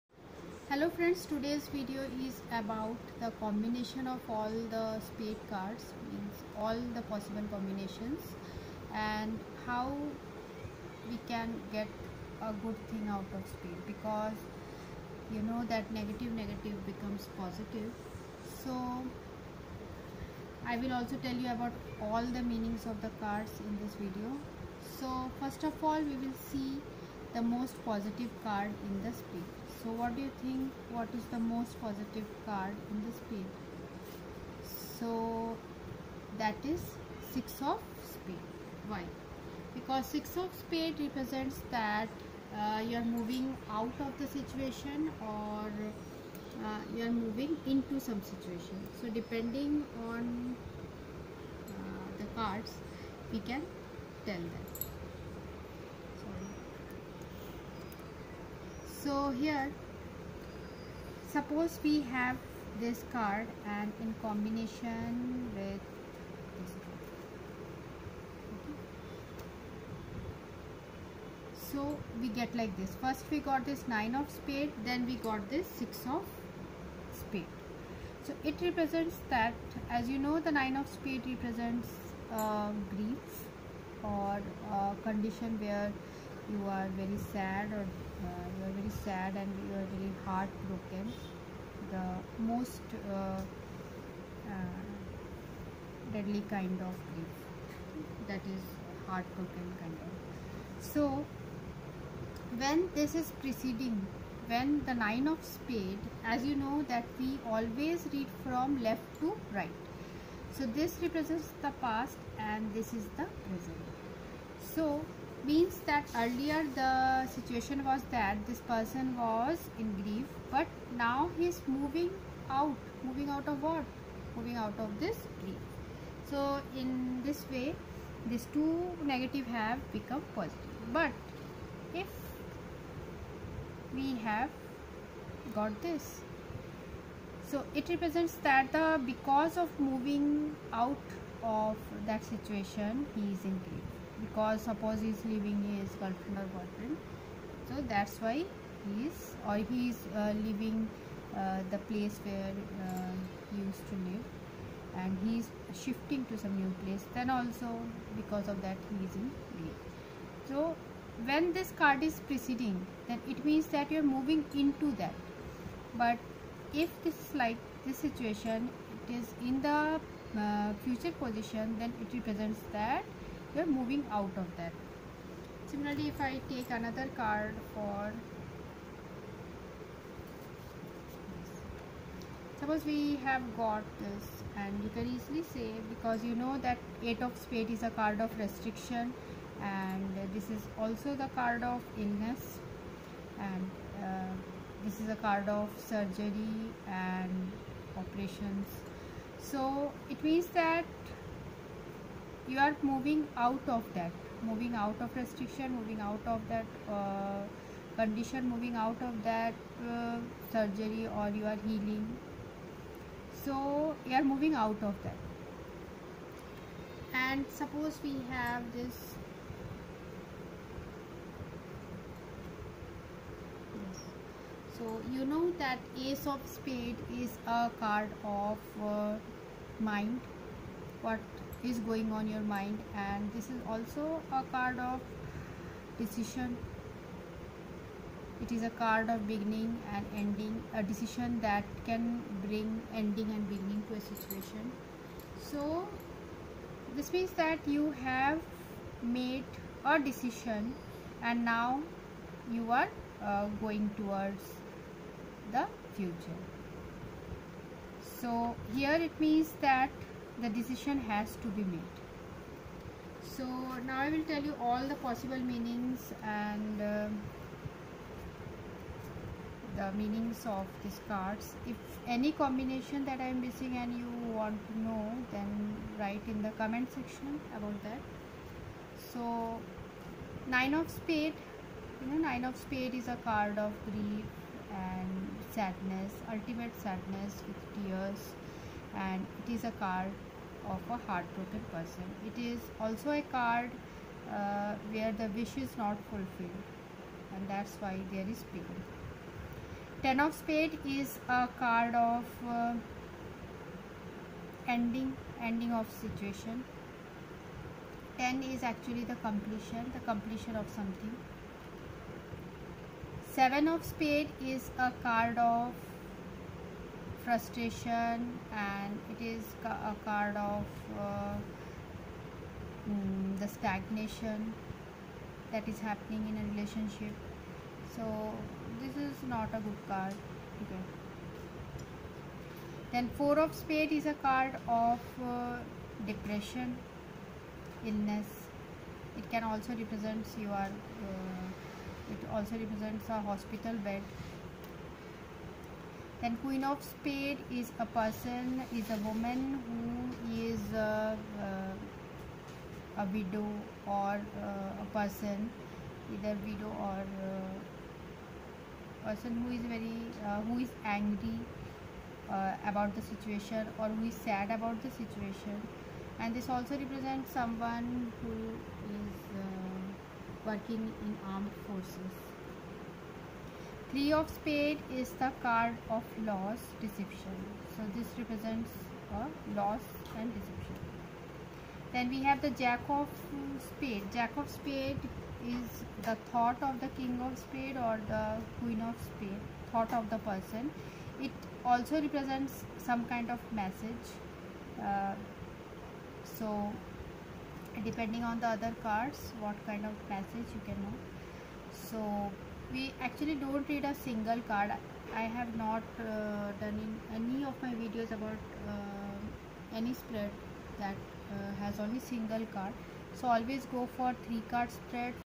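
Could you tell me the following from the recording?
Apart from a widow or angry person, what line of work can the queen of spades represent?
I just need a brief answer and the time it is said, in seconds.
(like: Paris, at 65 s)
armed forces, at 371 s.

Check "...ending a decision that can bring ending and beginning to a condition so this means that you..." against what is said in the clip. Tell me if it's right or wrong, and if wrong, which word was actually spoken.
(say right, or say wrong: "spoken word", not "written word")
wrong: "situation", not "condition".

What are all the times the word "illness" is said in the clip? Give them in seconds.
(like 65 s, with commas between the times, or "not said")
191 s, 337 s.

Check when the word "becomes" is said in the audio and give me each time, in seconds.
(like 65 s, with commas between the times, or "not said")
16 s, 129 s.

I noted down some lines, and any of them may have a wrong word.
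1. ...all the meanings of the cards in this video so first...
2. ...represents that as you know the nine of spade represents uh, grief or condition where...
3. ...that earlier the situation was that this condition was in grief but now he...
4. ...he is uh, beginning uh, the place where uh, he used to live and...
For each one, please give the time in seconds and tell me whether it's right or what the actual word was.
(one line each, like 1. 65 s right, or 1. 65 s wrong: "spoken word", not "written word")
1. 22 s right
2. 78 s right
3. 115 s wrong: "person", not "condition"
4. 149 s wrong: "leaving", not "beginning".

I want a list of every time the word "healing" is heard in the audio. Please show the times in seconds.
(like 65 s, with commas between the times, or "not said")
211 s.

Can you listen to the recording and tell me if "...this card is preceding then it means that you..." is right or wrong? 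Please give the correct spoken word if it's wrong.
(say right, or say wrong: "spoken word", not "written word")
right.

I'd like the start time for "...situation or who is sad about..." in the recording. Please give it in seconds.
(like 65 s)
363 s.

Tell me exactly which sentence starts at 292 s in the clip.
It is also a card uh, where the wish is not fulfilled and that's why there is pain.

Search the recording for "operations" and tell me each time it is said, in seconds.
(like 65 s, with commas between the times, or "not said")
197 s.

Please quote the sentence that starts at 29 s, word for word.
So what do you think what is the most positive card in the spade?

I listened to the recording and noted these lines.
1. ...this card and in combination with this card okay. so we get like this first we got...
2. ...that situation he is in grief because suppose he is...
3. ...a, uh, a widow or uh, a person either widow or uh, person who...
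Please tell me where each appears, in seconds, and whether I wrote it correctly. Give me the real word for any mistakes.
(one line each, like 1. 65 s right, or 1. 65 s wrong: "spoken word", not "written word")
1. 62 s right
2. 142 s right
3. 351 s right.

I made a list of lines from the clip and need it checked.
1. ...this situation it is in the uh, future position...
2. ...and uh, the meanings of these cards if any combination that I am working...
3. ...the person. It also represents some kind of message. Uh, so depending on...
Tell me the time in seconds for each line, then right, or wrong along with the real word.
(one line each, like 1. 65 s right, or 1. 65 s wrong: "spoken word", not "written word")
1. 167 s right
2. 266 s wrong: "missing", not "working"
3. 390 s right.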